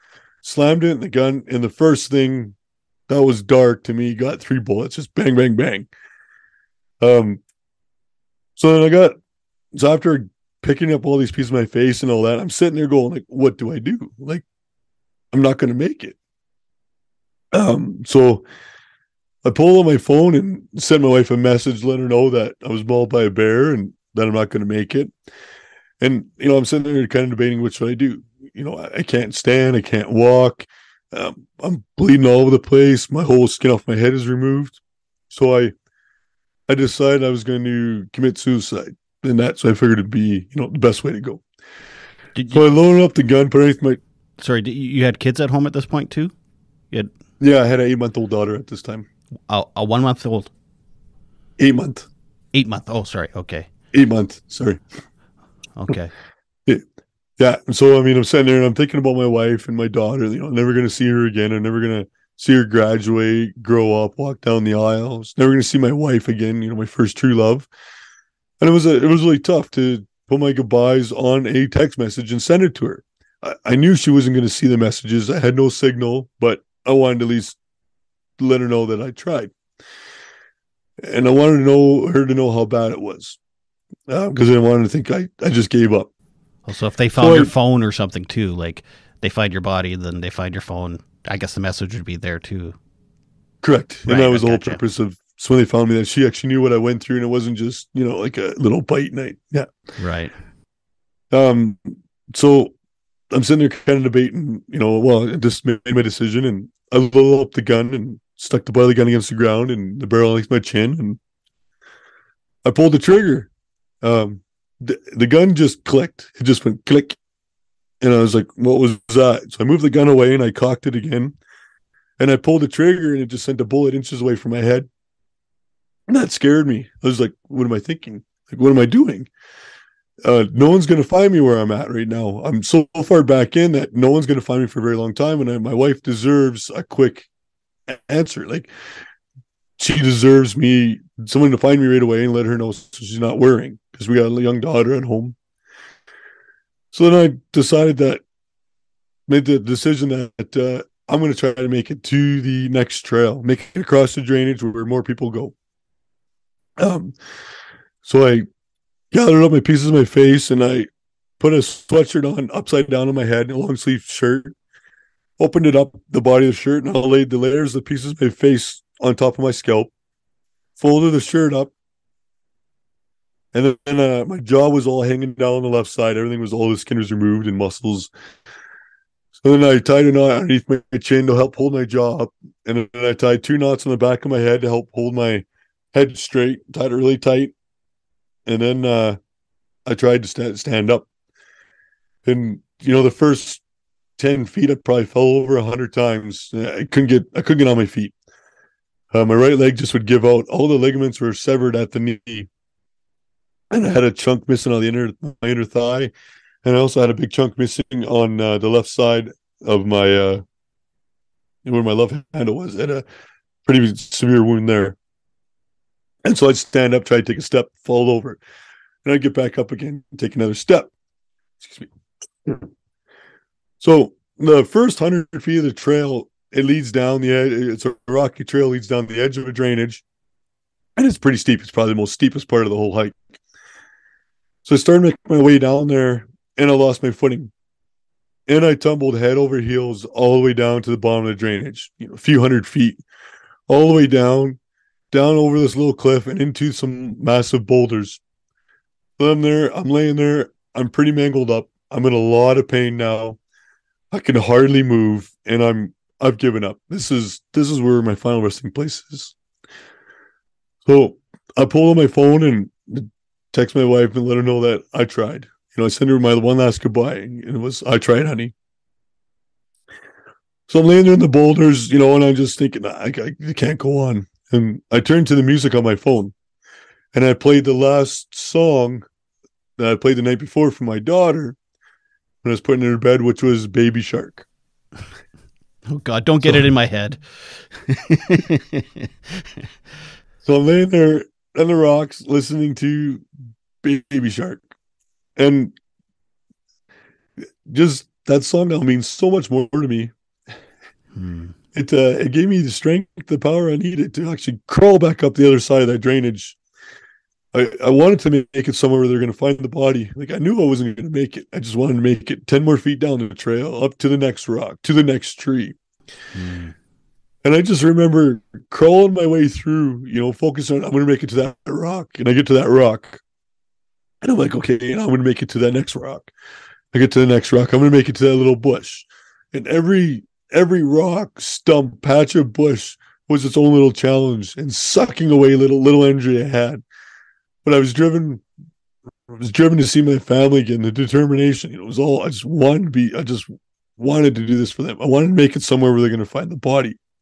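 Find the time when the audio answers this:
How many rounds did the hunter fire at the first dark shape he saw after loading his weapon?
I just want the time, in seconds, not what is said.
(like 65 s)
4 s.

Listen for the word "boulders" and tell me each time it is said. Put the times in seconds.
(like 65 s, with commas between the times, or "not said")
247 s, 271 s.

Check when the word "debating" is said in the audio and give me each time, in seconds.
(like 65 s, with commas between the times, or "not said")
27 s, 104 s.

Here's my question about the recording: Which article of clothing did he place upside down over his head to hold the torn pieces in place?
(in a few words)
Sweatshirt.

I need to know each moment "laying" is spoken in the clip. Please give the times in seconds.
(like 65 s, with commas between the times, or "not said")
249 s, 270 s, 290 s.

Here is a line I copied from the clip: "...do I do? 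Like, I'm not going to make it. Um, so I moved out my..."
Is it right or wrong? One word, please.
wrong.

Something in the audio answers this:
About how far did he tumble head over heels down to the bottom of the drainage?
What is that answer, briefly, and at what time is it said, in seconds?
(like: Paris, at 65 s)
A few hundred feet, at 242 s.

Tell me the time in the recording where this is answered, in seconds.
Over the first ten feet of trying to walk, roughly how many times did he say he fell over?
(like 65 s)
195 s.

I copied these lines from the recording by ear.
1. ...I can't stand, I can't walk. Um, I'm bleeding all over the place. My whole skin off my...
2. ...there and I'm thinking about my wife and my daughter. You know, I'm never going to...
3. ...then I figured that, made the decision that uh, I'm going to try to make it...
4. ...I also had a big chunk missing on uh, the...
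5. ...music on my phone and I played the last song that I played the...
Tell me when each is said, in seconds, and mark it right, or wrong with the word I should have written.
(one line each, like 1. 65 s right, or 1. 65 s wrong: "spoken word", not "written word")
1. 28 s right
2. 58 s right
3. 147 s wrong: "decided", not "figured"
4. 206 s right
5. 275 s right.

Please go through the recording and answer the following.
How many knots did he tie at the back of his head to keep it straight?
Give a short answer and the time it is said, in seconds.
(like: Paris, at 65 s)
2, at 183 s.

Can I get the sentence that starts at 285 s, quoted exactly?
Oh God, don't get so, it in my head.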